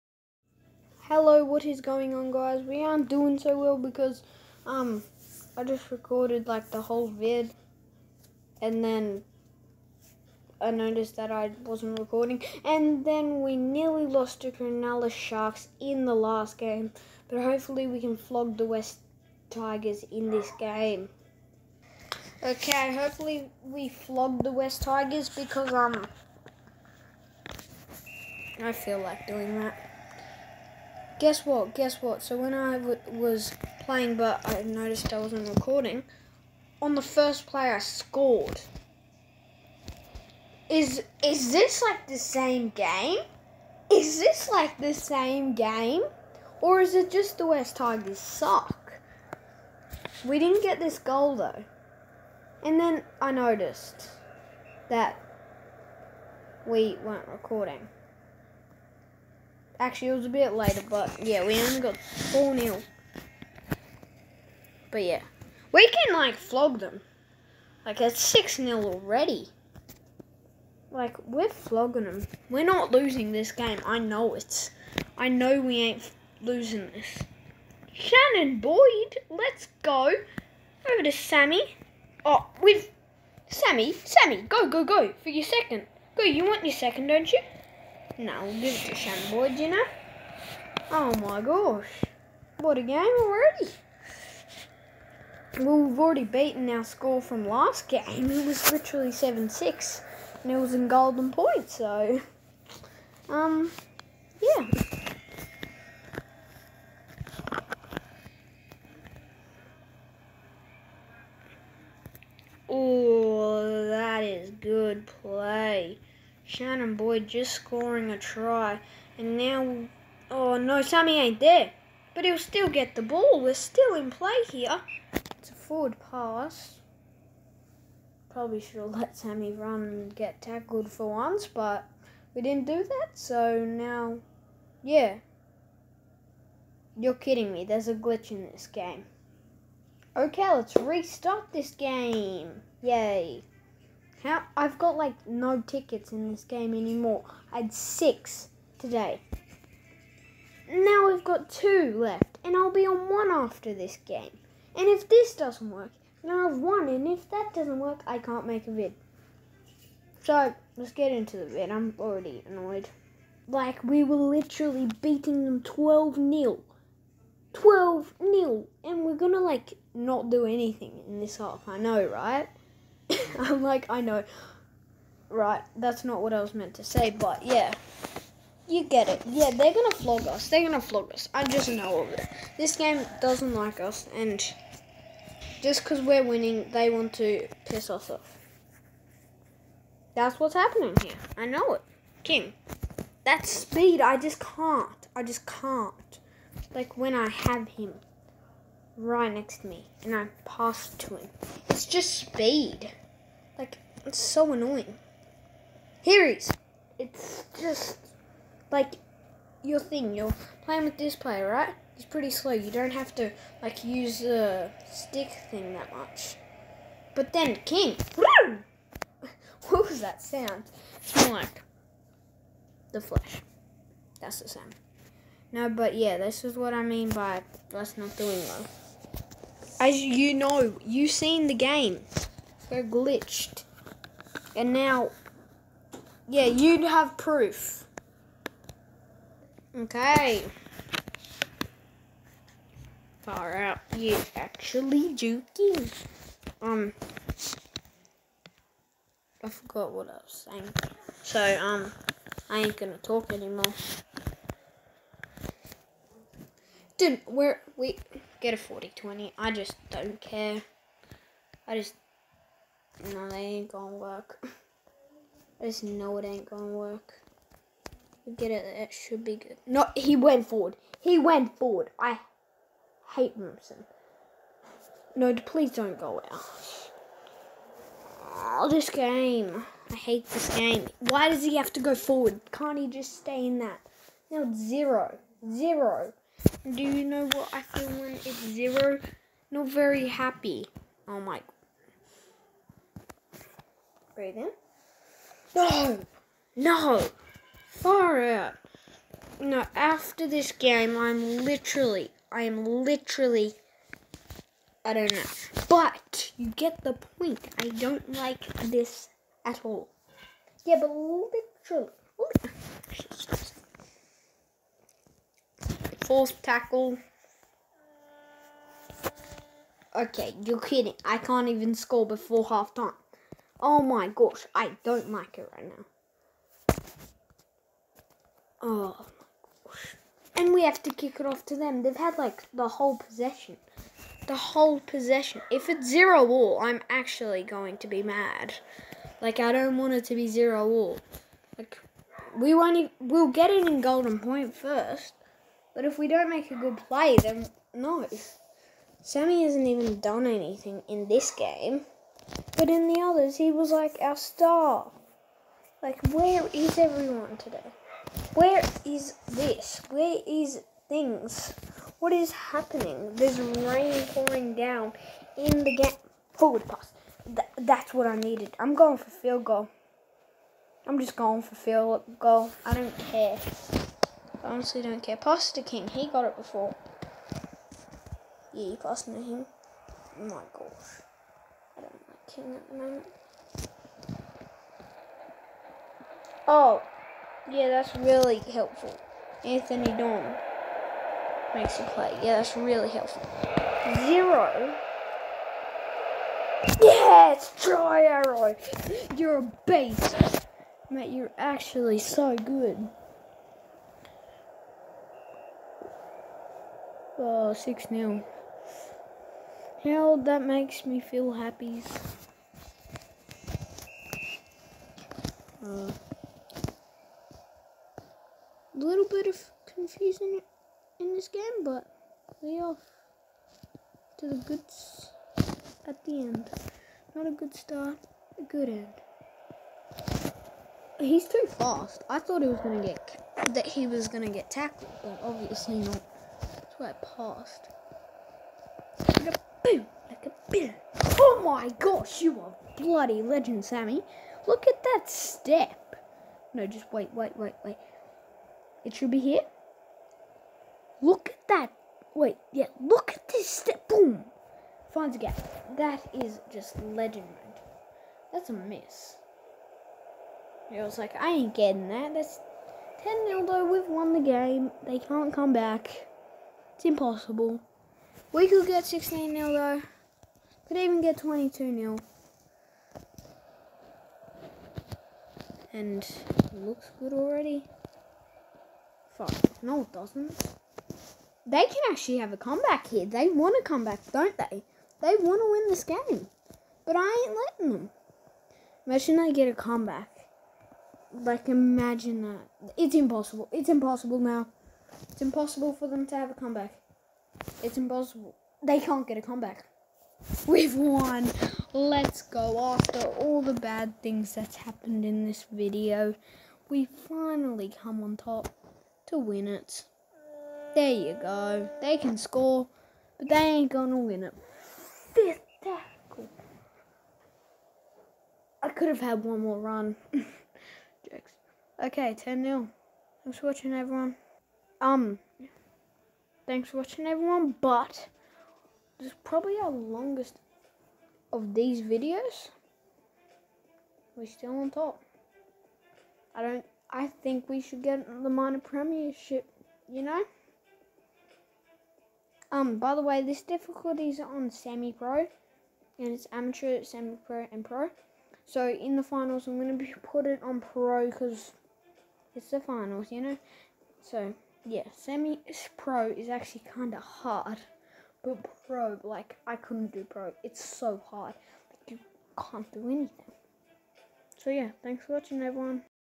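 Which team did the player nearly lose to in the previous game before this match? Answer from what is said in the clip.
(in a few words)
Cronulla Sharks.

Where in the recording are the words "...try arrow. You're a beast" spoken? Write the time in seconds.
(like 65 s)
397 s.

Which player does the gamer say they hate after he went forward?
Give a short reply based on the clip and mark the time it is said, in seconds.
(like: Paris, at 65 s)
Wilson, at 273 s.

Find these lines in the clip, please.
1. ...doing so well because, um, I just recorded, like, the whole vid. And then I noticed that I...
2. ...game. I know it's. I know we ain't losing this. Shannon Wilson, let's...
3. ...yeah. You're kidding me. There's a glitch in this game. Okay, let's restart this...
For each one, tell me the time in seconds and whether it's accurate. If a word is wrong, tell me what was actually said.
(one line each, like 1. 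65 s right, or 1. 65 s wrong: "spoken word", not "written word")
1. 3 s right
2. 73 s wrong: "Boyd", not "Wilson"
3. 134 s right.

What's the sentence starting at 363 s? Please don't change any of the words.
There's rain pouring down in the gap.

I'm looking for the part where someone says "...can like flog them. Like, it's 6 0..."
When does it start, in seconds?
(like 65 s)
65 s.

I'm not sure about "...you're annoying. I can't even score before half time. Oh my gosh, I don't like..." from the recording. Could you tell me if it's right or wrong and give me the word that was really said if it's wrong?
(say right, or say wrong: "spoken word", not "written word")
wrong: "kidding", not "annoying".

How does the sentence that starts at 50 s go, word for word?
We didn't get this goal though.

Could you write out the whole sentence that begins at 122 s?
But he'll still get the ball.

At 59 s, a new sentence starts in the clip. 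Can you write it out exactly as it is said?
Actually, it was a bit later, but yeah, we only got 4 0.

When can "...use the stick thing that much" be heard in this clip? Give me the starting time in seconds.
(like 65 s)
213 s.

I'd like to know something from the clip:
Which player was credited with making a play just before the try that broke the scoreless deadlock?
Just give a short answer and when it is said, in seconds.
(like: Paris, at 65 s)
Anthony Don, at 389 s.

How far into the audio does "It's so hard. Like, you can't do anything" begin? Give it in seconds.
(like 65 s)
560 s.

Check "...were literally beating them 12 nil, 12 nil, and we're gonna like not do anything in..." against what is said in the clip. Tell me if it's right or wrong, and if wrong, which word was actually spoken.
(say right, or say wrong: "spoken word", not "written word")
right.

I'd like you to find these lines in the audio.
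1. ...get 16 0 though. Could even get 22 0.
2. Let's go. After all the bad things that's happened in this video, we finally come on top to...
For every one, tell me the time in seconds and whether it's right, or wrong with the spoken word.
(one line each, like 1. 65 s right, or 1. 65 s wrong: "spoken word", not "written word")
1. 468 s right
2. 501 s right.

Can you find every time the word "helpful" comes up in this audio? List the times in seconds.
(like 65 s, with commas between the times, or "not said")
388 s, 392 s.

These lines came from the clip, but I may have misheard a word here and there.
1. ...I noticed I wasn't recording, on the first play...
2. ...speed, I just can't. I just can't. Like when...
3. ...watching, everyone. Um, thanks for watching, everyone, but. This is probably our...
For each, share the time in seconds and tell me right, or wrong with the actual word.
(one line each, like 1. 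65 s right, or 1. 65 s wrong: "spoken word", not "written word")
1. 34 s right
2. 193 s right
3. 523 s right.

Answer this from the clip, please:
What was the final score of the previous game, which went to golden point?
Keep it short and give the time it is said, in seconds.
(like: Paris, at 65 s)
7-6, at 99 s.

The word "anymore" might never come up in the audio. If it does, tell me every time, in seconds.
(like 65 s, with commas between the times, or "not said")
146 s, 253 s.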